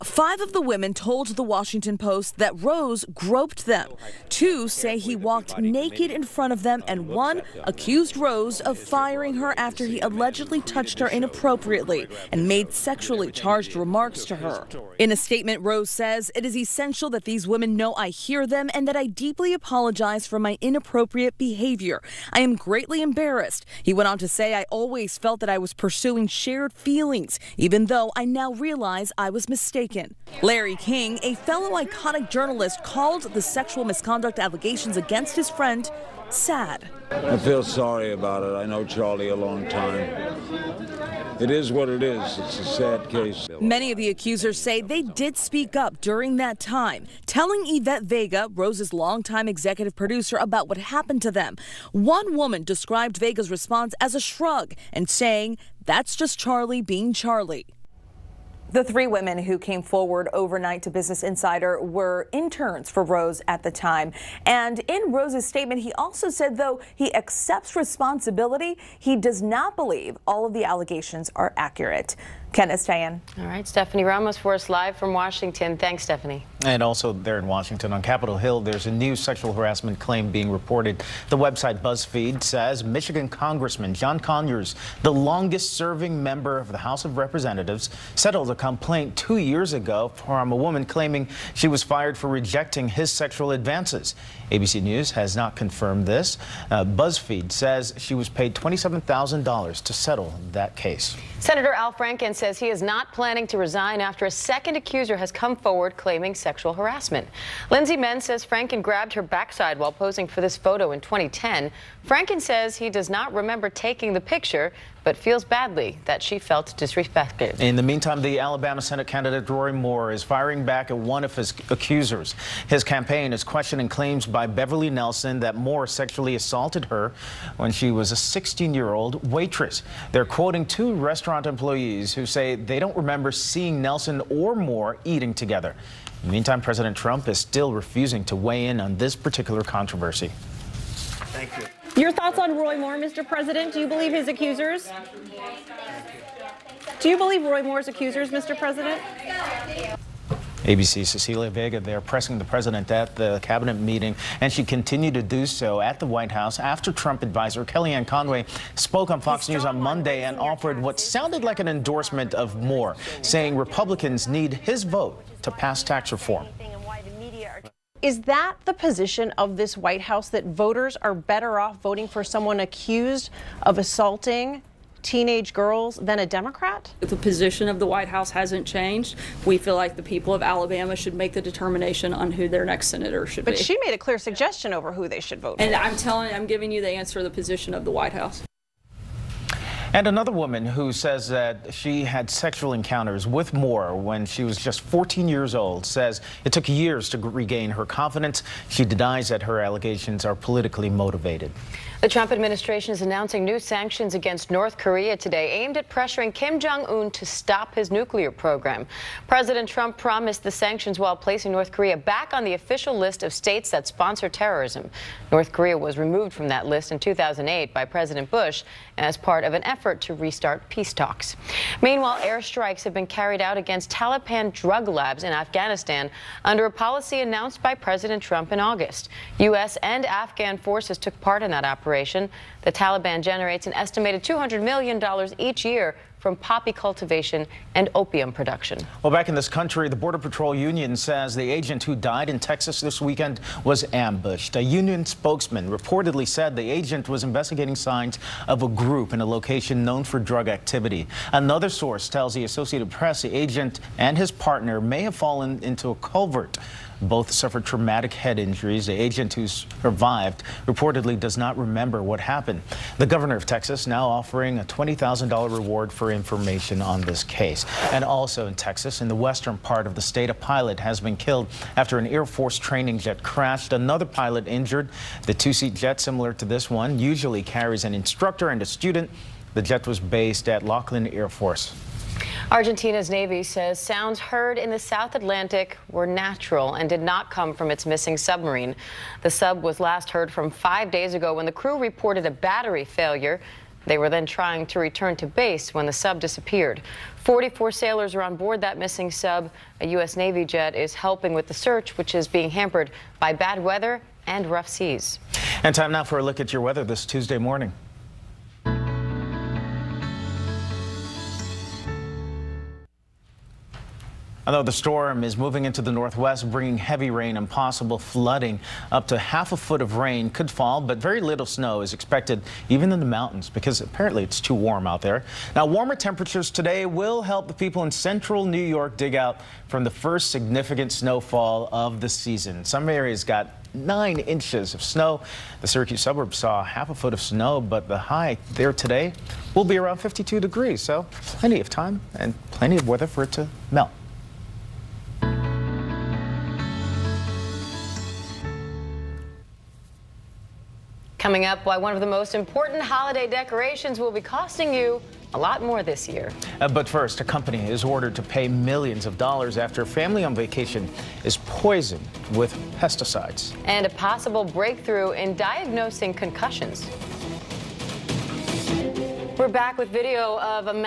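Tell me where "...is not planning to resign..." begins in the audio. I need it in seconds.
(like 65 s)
102 s.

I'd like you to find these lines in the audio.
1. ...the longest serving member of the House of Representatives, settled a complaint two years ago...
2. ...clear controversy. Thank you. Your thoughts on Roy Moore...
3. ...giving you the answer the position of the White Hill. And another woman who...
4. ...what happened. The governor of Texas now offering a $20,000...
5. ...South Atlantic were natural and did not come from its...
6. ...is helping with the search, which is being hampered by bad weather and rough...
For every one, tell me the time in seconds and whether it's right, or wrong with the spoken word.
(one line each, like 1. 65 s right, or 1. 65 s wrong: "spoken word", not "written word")
1. 85 s right
2. 139 s wrong: "particular", not "clear"
3. 186 s wrong: "House", not "Hill"
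4. 262 s right
5. 284 s right
6. 300 s right.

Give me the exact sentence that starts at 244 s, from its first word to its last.
A union spokesman reportedly said the agent was investigating signs of a group in a location known for drug activity.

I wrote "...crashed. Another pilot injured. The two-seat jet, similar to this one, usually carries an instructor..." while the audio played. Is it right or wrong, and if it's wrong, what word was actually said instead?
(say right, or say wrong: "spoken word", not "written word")
right.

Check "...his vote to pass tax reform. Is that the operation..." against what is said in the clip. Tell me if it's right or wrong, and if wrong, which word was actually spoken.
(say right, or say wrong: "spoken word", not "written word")
wrong: "position", not "operation".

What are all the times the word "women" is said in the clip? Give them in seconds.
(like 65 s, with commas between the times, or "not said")
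0 s, 17 s, 59 s.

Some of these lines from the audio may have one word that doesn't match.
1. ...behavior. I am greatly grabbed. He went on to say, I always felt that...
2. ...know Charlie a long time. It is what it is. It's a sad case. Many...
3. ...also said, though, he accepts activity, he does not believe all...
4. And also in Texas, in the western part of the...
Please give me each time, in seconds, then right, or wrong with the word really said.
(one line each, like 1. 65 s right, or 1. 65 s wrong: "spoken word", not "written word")
1. 21 s wrong: "embarrassed", not "grabbed"
2. 38 s right
3. 65 s wrong: "responsibility", not "activity"
4. 267 s right.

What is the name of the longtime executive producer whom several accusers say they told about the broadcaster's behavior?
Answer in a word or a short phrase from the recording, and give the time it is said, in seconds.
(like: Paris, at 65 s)
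Yvette Vega, at 47 s.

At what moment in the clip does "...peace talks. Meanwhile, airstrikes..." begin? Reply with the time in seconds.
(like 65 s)
220 s.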